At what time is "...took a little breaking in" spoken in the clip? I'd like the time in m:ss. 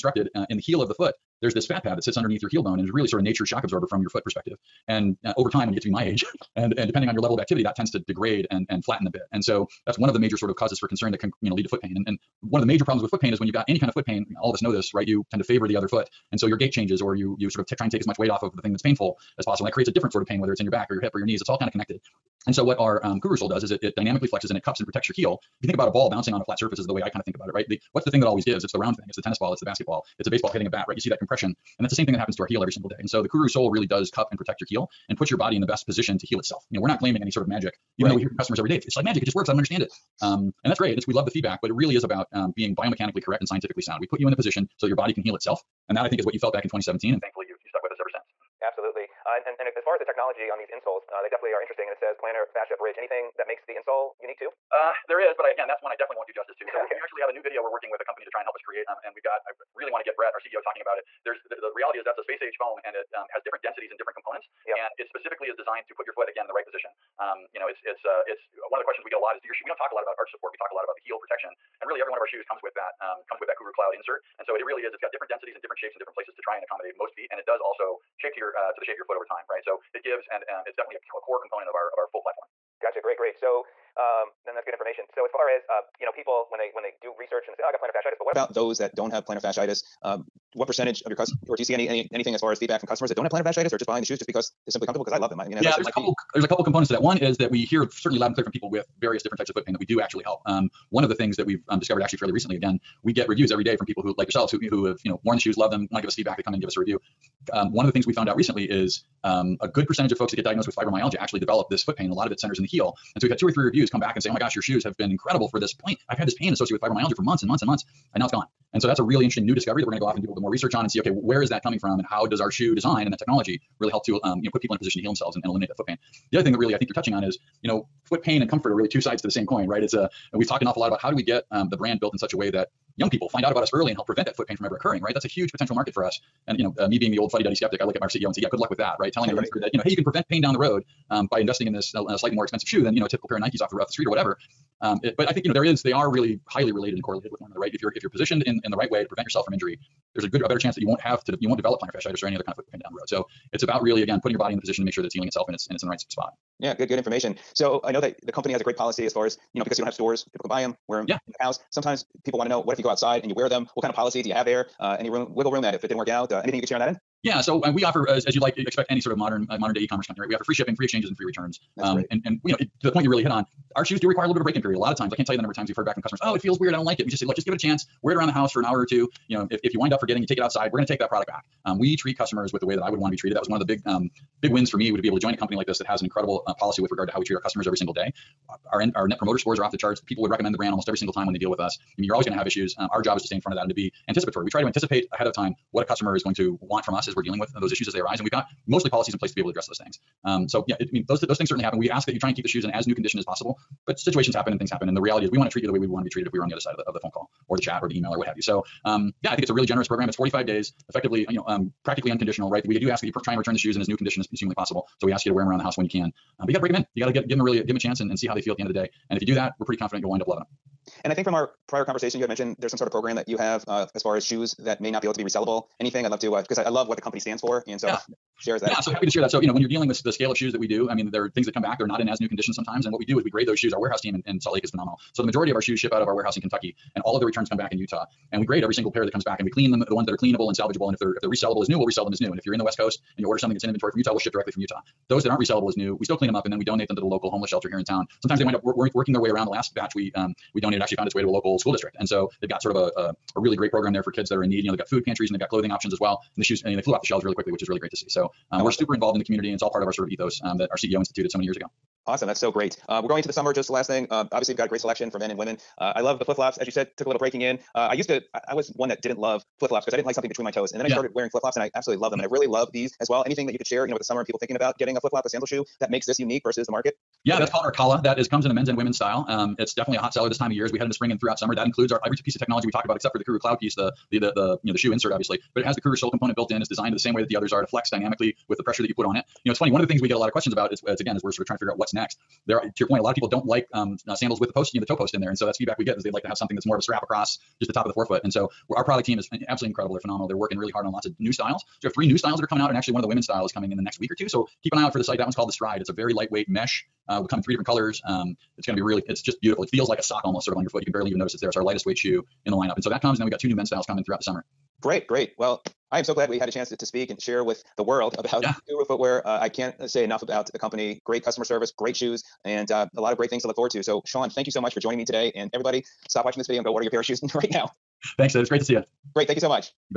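4:26.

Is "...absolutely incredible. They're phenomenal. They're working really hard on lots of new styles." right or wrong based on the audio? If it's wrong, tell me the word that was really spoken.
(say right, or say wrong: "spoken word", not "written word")
right.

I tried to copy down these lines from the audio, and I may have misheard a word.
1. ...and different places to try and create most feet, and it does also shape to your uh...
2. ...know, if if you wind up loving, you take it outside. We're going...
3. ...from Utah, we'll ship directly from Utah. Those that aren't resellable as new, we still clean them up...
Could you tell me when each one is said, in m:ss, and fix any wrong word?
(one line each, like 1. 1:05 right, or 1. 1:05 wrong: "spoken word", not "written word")
1. 1:15 wrong: "accommodate", not "create"
2. 2:59 wrong: "forgetting", not "loving"
3. 4:03 right.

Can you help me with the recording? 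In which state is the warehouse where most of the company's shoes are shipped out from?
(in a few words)
Kentucky.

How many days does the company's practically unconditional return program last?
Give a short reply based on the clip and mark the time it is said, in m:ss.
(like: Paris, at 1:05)
45, at 3:30.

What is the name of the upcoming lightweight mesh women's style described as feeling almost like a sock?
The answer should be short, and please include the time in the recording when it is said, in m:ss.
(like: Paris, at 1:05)
Stride, at 5:05.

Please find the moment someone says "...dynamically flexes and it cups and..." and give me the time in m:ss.
0:23.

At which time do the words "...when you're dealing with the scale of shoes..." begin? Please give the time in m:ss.
3:49.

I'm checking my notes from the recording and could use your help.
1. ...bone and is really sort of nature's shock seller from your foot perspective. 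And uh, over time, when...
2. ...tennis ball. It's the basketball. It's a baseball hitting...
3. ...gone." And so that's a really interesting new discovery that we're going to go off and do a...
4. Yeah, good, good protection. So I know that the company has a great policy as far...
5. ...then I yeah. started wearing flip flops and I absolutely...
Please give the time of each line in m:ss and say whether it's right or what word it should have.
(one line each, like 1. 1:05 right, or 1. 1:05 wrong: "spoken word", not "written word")
1. 0:02 wrong: "absorber", not "seller"
2. 0:29 right
3. 1:58 right
4. 2:36 wrong: "information", not "protection"
5. 4:30 right.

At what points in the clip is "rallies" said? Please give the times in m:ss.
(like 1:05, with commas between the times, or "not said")
not said.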